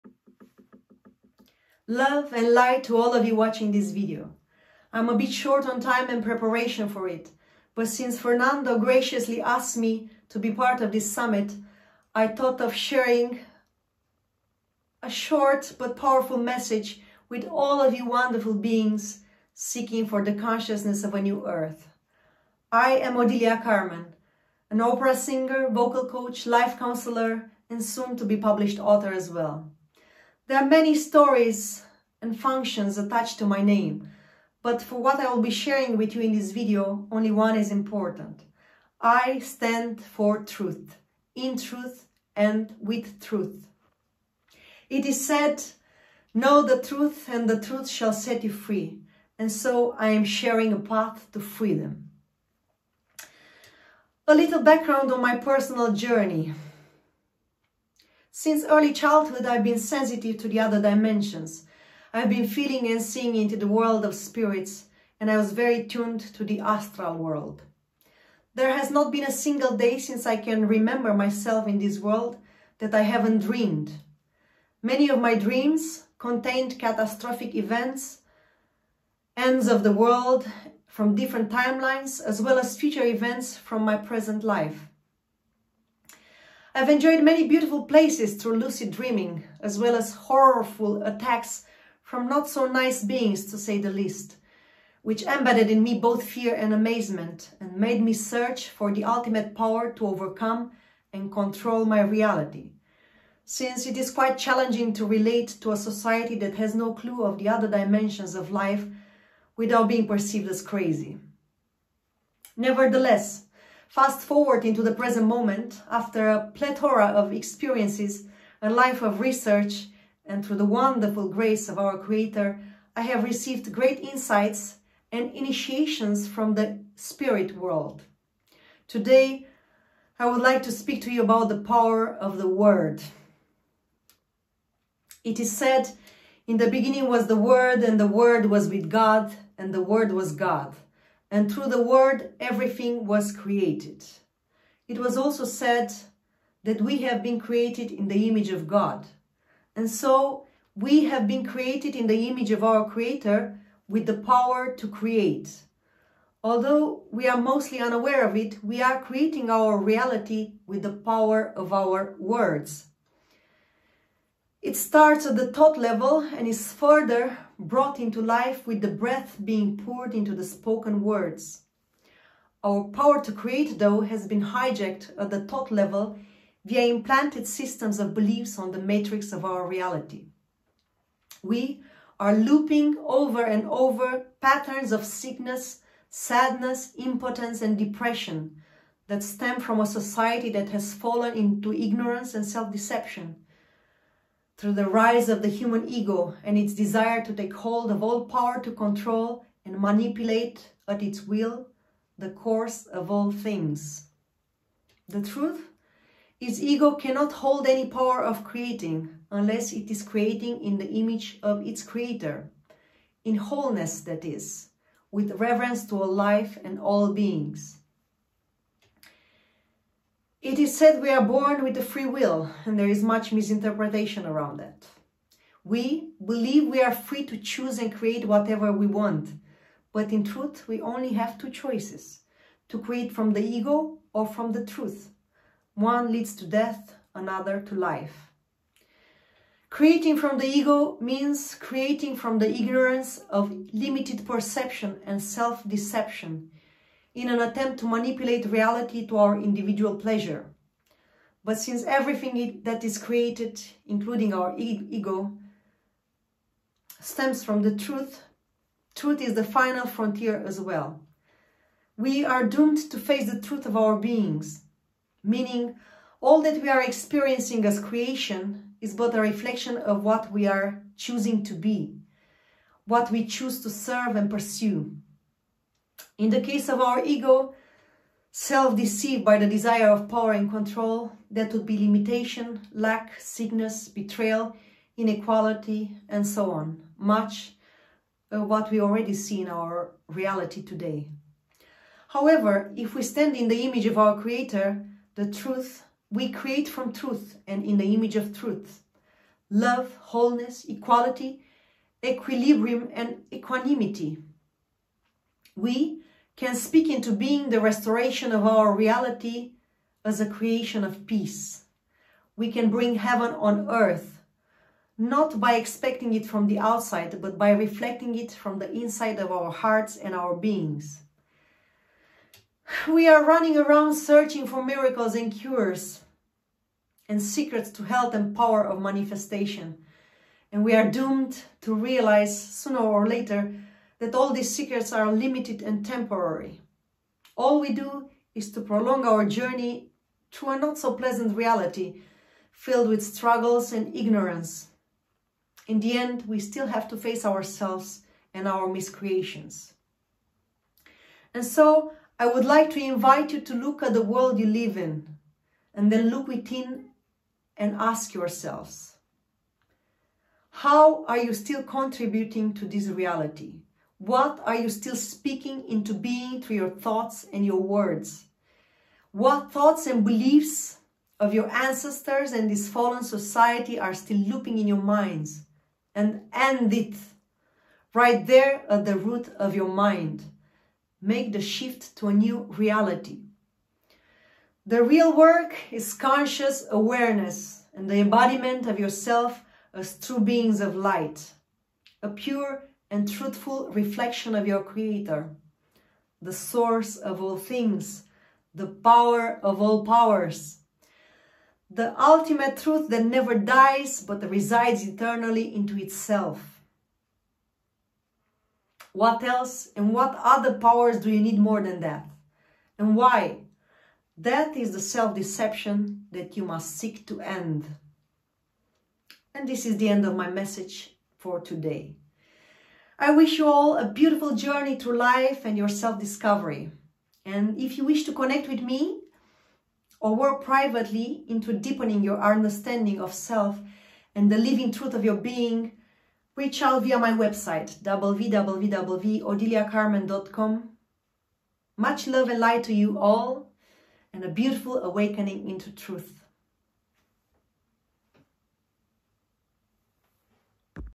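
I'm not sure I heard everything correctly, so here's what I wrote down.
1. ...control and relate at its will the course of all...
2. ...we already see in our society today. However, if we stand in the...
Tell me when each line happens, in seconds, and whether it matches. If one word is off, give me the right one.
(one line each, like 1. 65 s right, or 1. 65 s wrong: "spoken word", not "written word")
1. 198 s wrong: "manipulate", not "relate"
2. 288 s wrong: "reality", not "society".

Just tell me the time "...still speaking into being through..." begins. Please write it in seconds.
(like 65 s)
364 s.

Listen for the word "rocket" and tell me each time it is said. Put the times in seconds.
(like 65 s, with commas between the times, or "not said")
not said.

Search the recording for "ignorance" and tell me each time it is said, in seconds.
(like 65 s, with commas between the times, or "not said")
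191 s, 242 s, 343 s.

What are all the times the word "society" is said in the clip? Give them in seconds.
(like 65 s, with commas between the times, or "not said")
105 s, 189 s, 373 s.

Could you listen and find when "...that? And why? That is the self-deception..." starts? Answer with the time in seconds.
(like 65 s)
411 s.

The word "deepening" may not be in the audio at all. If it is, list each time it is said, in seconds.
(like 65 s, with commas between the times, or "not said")
431 s.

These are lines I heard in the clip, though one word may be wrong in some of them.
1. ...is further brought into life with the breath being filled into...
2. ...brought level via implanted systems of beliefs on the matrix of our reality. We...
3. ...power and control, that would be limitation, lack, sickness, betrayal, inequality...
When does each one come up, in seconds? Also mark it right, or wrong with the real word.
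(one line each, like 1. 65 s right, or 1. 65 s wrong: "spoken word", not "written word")
1. 166 s wrong: "poured", not "filled"
2. 175 s wrong: "thought", not "brought"
3. 280 s right.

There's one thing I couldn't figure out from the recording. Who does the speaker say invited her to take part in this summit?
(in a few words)
Fernando.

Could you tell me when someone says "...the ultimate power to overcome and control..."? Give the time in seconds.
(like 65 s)
98 s.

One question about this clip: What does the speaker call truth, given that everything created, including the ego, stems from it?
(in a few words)
The final frontier.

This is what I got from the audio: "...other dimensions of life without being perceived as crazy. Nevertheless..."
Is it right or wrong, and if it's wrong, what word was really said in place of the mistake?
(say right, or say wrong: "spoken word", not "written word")
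right.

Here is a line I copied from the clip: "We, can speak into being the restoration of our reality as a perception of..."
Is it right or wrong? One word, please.
wrong.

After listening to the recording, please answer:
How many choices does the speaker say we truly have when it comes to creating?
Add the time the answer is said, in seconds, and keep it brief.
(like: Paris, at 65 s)
2, at 231 s.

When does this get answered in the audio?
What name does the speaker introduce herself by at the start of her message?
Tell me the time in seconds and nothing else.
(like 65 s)
23 s.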